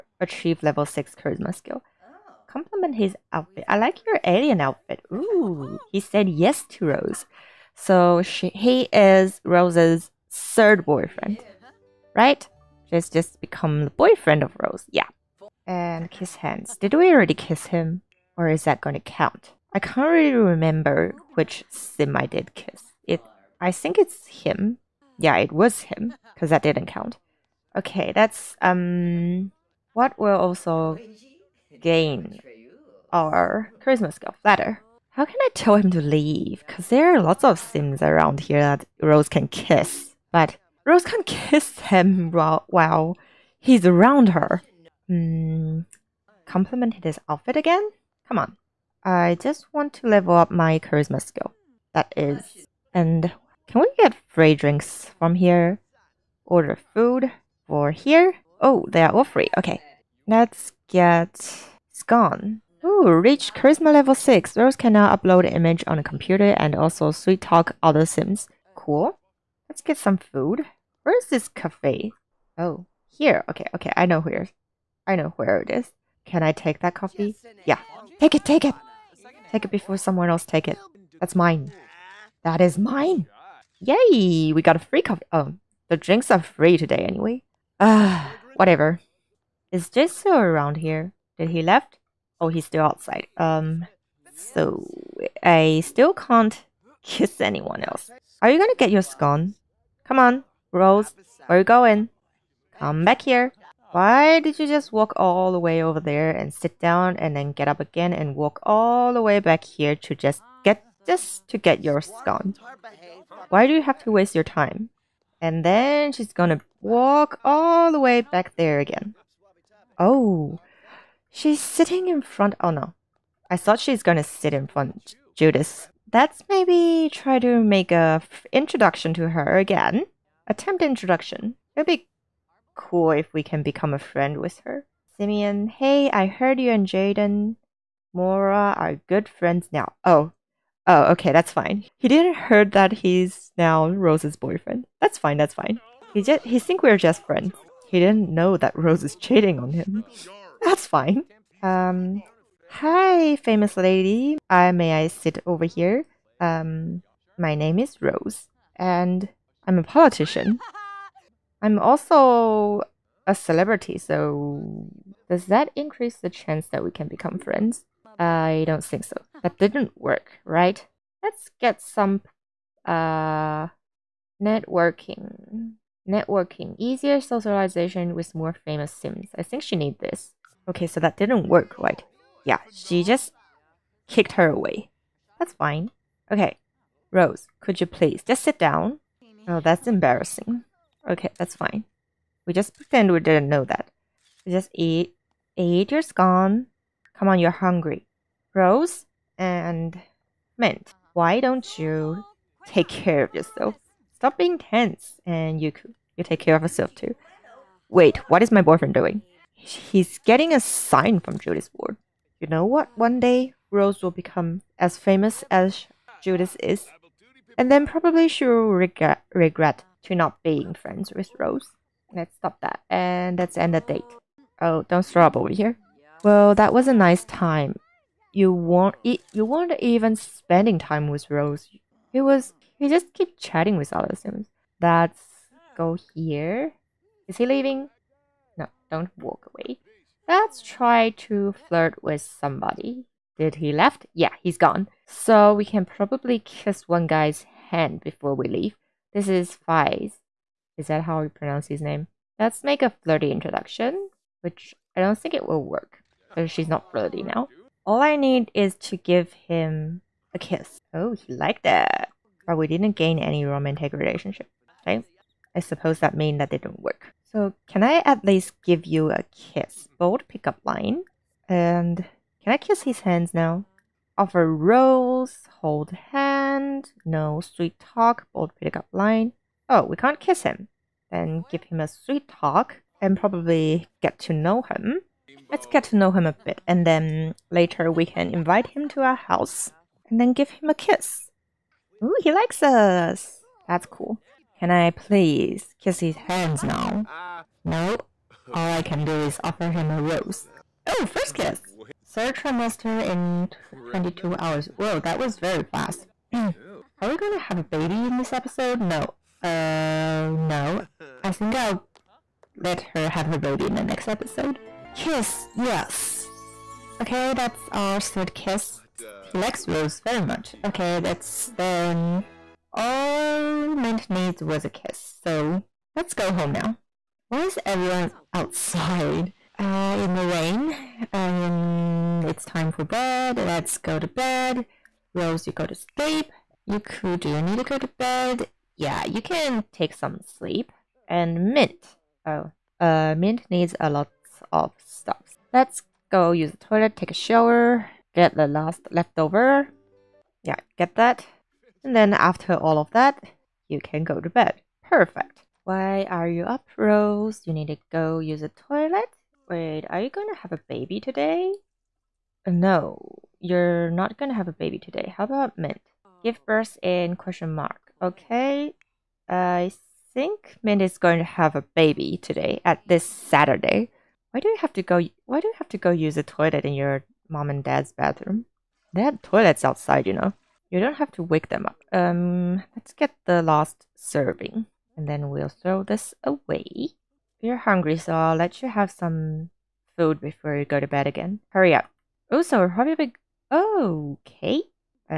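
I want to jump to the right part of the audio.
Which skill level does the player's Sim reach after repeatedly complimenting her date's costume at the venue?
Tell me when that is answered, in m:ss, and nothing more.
1:03.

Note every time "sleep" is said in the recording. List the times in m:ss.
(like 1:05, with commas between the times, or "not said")
5:35, 5:40.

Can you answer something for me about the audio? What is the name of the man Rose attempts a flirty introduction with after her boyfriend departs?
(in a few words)
Fize.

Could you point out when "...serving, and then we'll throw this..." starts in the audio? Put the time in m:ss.
6:23.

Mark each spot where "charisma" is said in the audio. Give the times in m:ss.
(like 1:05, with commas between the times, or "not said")
0:01, 0:33, 0:50, 1:03.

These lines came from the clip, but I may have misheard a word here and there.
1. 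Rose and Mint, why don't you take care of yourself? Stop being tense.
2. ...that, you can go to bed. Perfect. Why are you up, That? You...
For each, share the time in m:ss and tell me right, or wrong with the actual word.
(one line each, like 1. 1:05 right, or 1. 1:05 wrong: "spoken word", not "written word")
1. 3:18 right
2. 5:52 wrong: "Rose", not "That".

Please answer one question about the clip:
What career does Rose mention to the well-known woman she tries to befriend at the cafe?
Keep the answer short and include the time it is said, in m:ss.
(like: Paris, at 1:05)
Politician, at 2:39.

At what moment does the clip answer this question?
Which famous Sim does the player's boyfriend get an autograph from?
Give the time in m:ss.
3:31.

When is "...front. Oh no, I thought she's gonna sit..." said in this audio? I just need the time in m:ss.
2:02.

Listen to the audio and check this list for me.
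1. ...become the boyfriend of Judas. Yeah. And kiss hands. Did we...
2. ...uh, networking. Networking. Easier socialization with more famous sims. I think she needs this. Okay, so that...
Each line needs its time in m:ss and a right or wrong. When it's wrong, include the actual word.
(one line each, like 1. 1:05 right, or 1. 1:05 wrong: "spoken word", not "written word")
1. 0:13 wrong: "Rose", not "Judas"
2. 2:52 right.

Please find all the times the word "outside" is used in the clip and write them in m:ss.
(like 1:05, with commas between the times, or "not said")
1:32, 5:28, 6:19.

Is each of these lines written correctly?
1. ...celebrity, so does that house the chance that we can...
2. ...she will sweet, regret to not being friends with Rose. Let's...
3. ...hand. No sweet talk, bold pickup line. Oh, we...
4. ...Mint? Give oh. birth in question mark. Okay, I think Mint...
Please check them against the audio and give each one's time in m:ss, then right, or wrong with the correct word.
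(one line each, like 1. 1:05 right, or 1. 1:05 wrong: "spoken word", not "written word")
1. 2:43 wrong: "increase", not "house"
2. 3:38 wrong: "regret", not "sweet"
3. 4:36 right
4. 6:05 right.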